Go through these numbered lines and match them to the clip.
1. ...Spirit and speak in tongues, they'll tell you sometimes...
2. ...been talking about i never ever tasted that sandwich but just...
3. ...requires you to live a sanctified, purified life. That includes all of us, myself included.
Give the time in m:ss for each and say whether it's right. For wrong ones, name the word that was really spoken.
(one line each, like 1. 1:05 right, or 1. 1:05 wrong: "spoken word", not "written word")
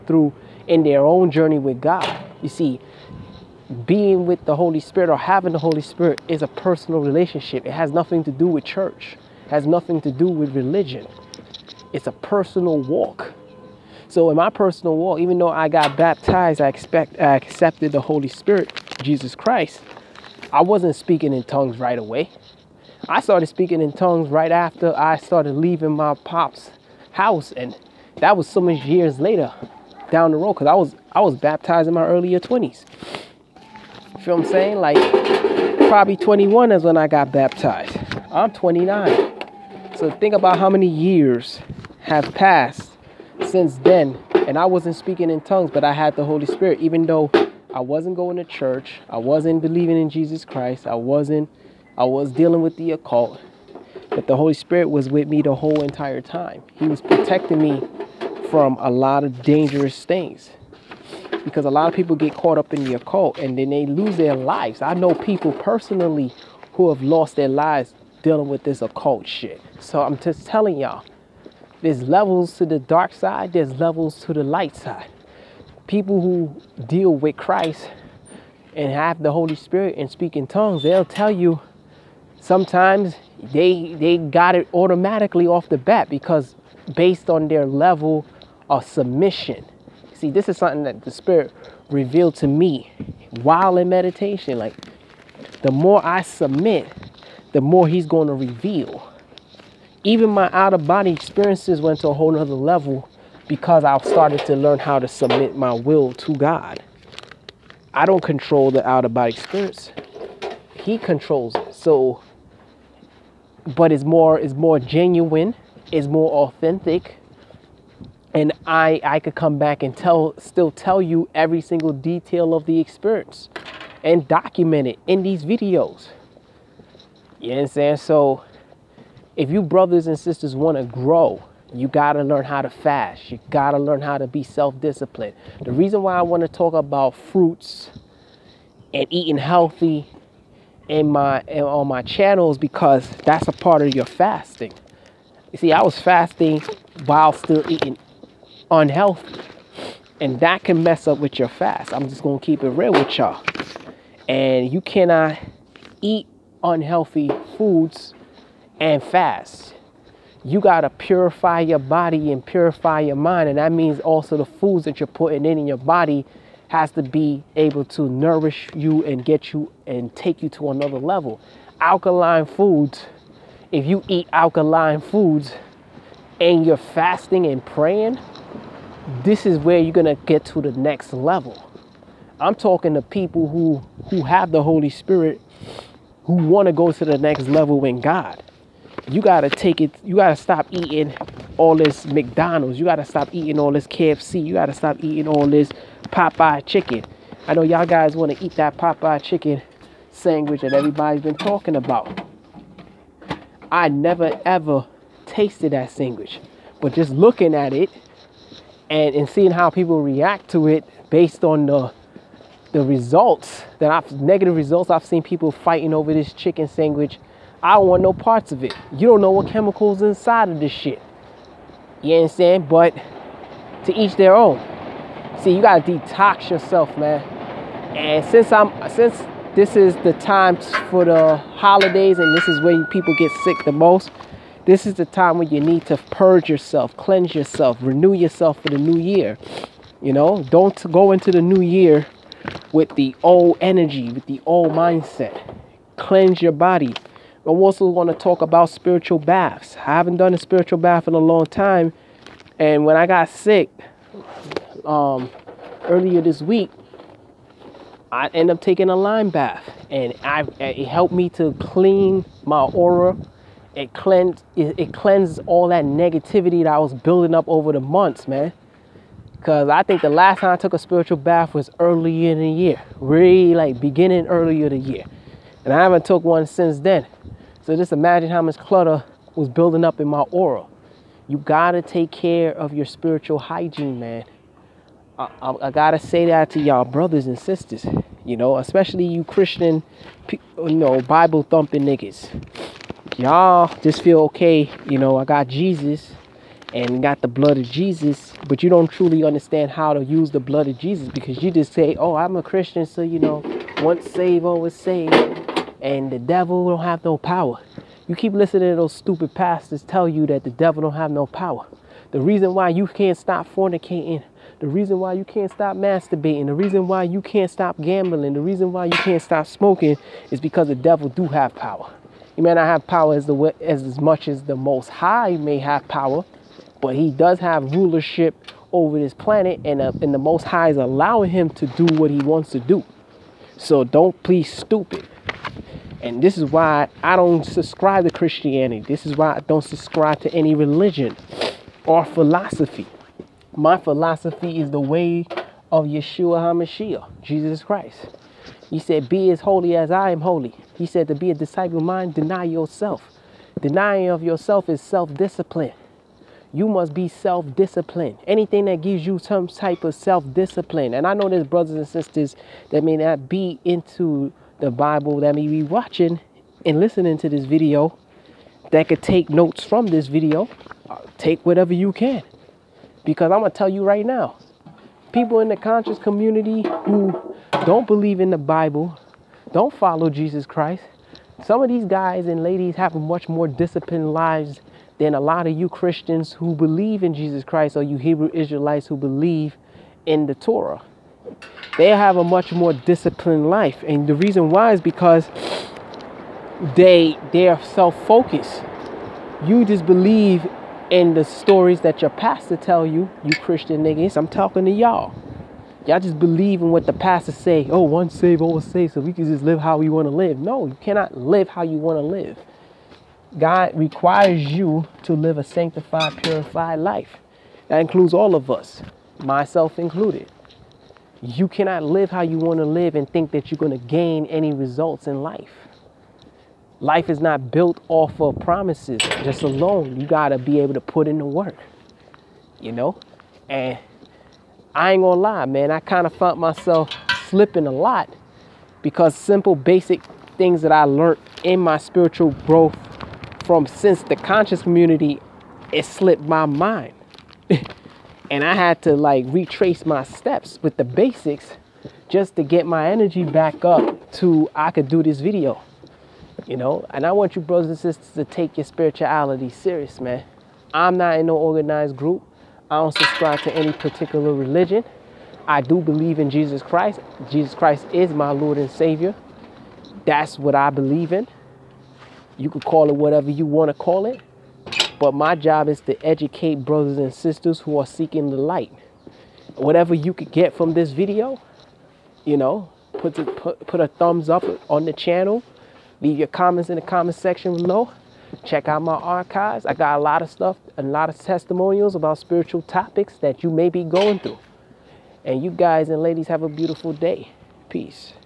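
1. 1:19 right
2. 3:21 right
3. 6:53 right.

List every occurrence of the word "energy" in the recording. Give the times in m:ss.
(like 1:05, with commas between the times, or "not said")
4:03, 7:32.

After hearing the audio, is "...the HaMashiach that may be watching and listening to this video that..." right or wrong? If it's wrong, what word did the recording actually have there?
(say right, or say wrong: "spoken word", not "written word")
wrong: "Bible", not "HaMashiach".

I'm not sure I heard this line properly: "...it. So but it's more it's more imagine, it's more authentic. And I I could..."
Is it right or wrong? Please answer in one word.
wrong.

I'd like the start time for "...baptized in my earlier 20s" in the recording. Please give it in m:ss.
0:31.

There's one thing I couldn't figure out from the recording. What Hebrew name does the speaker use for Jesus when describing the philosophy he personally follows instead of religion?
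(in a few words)
Yeshua HaMashiach.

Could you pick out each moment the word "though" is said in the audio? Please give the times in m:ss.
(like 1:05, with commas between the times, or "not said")
0:15, 0:47.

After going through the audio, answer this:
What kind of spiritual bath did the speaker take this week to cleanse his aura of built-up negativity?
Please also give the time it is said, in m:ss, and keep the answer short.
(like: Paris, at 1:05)
Lime bath, at 4:18.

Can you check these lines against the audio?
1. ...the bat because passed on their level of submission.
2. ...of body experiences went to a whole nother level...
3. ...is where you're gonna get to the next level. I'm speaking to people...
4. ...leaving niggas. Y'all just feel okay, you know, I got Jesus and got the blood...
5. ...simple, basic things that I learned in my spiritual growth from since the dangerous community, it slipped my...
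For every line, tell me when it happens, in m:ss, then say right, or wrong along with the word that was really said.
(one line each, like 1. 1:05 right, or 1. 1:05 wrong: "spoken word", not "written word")
1. 1:25 wrong: "based", not "passed"
2. 1:40 right
3. 2:59 wrong: "talking", not "speaking"
4. 4:51 wrong: "thumping", not "leaving"
5. 7:19 wrong: "conscious", not "dangerous".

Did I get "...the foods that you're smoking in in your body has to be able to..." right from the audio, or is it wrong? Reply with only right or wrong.
wrong.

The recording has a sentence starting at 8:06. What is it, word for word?
Leave your comments in the comment section below.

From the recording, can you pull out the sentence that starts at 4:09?
I haven't done a spiritual bath in a long time.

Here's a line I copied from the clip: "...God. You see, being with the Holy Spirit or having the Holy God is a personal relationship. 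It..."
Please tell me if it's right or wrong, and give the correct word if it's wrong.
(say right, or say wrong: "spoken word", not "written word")
wrong: "Spirit", not "God".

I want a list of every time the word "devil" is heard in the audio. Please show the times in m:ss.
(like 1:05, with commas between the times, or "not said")
5:06, 5:10, 5:20.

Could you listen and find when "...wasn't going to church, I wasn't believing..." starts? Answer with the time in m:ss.
0:47.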